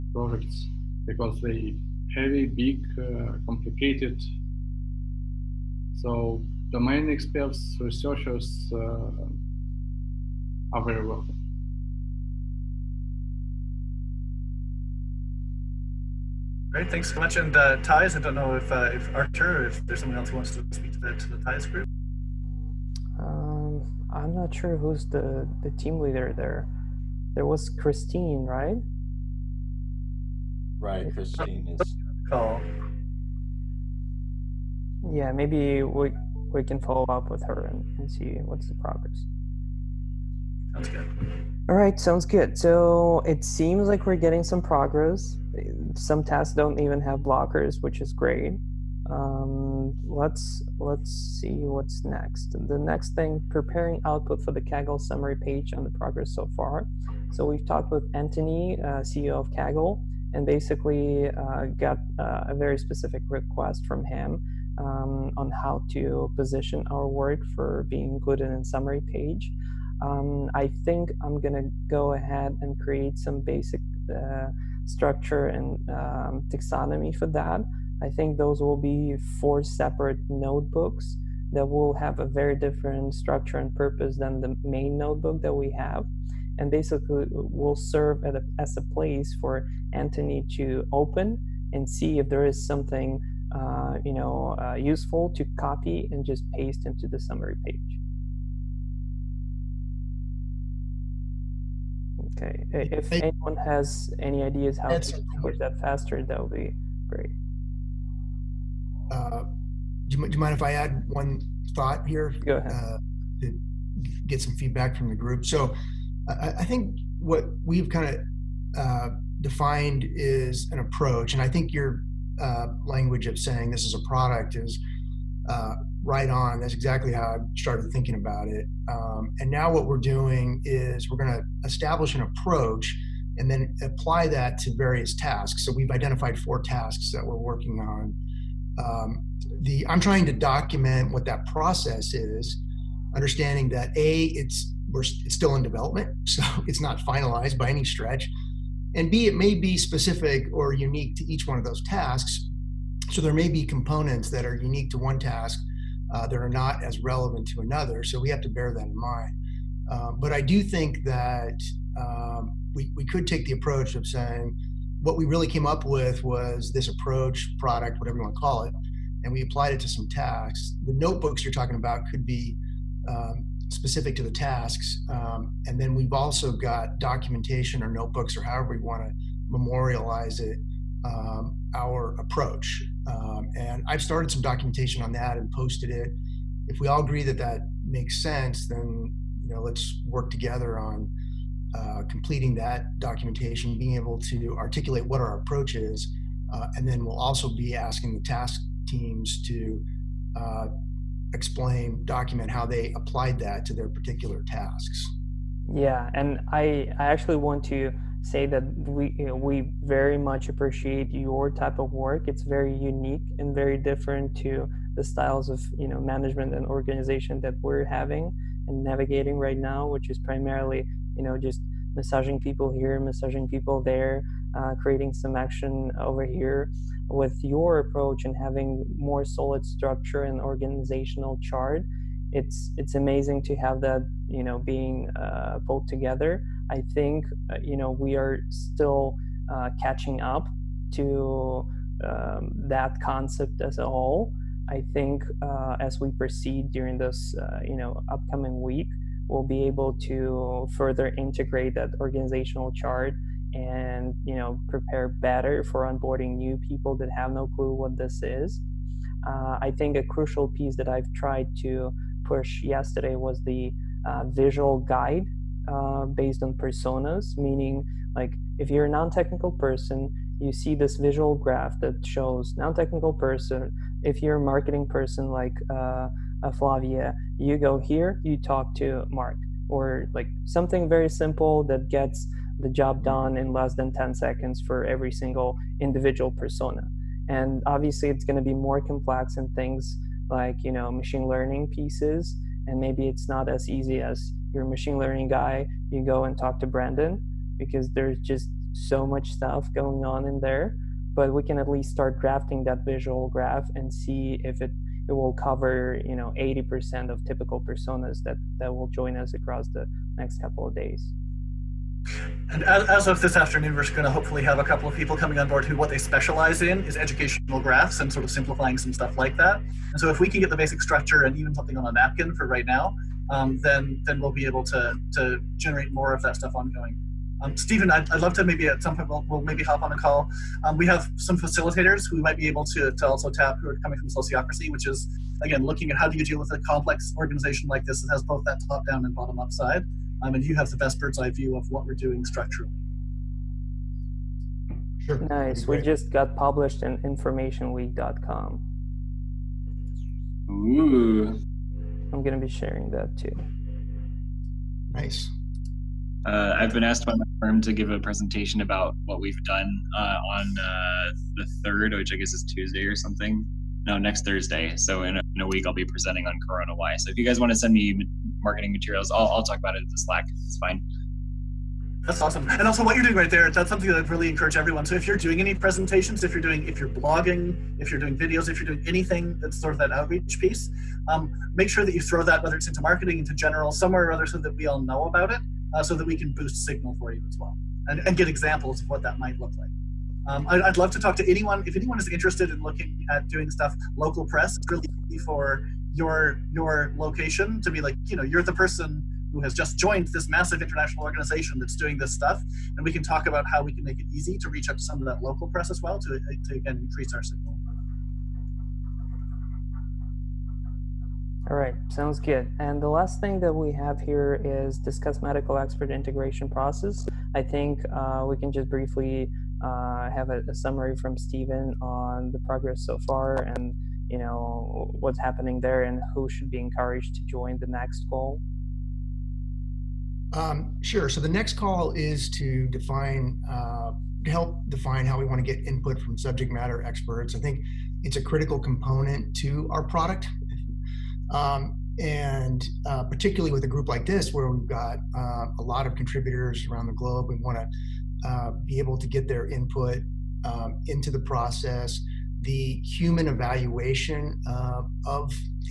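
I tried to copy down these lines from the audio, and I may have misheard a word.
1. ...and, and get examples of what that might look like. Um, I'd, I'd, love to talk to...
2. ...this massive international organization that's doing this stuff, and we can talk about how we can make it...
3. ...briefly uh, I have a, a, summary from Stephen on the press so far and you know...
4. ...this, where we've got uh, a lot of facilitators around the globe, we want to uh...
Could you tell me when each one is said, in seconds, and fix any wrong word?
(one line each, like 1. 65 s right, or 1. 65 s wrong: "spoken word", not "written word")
1. 387 s right
2. 400 s right
3. 418 s wrong: "progress", not "press"
4. 444 s wrong: "contributors", not "facilitators".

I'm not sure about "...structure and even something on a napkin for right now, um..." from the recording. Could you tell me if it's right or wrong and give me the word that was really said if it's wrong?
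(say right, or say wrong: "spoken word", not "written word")
right.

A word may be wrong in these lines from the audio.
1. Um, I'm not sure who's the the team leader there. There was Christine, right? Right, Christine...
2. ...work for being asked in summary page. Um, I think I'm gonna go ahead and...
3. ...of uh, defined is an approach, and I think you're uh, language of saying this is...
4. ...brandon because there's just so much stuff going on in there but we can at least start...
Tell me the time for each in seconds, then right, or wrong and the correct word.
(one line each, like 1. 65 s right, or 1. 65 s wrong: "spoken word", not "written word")
1. 23 s right
2. 67 s wrong: "included", not "asked"
3. 118 s right
4. 296 s right.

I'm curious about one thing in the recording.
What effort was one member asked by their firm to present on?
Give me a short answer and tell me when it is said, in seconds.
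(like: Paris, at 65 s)
CoronaWhy, at 366 s.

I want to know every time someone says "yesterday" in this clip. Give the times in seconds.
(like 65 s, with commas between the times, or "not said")
262 s.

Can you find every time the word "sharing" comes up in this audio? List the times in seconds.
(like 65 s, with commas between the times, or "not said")
352 s.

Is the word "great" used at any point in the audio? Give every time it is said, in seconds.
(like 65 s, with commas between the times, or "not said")
16 s, 48 s, 107 s.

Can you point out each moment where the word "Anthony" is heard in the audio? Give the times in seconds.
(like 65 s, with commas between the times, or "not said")
58 s, 89 s.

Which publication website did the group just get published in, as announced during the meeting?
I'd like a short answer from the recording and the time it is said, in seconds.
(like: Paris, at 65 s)
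InformationWeek.com, at 346 s.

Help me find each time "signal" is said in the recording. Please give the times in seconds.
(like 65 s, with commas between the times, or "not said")
386 s, 407 s.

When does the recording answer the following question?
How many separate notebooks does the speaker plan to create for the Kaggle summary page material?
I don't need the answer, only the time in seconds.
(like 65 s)
79 s.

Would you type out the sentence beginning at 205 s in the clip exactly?
Yeah, and I I actually want to say that we you know, we very much appreciate your type of work.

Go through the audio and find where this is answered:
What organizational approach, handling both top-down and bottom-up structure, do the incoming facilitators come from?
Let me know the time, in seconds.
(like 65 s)
334 s.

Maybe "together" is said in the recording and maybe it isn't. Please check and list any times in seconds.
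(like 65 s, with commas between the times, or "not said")
190 s, 235 s.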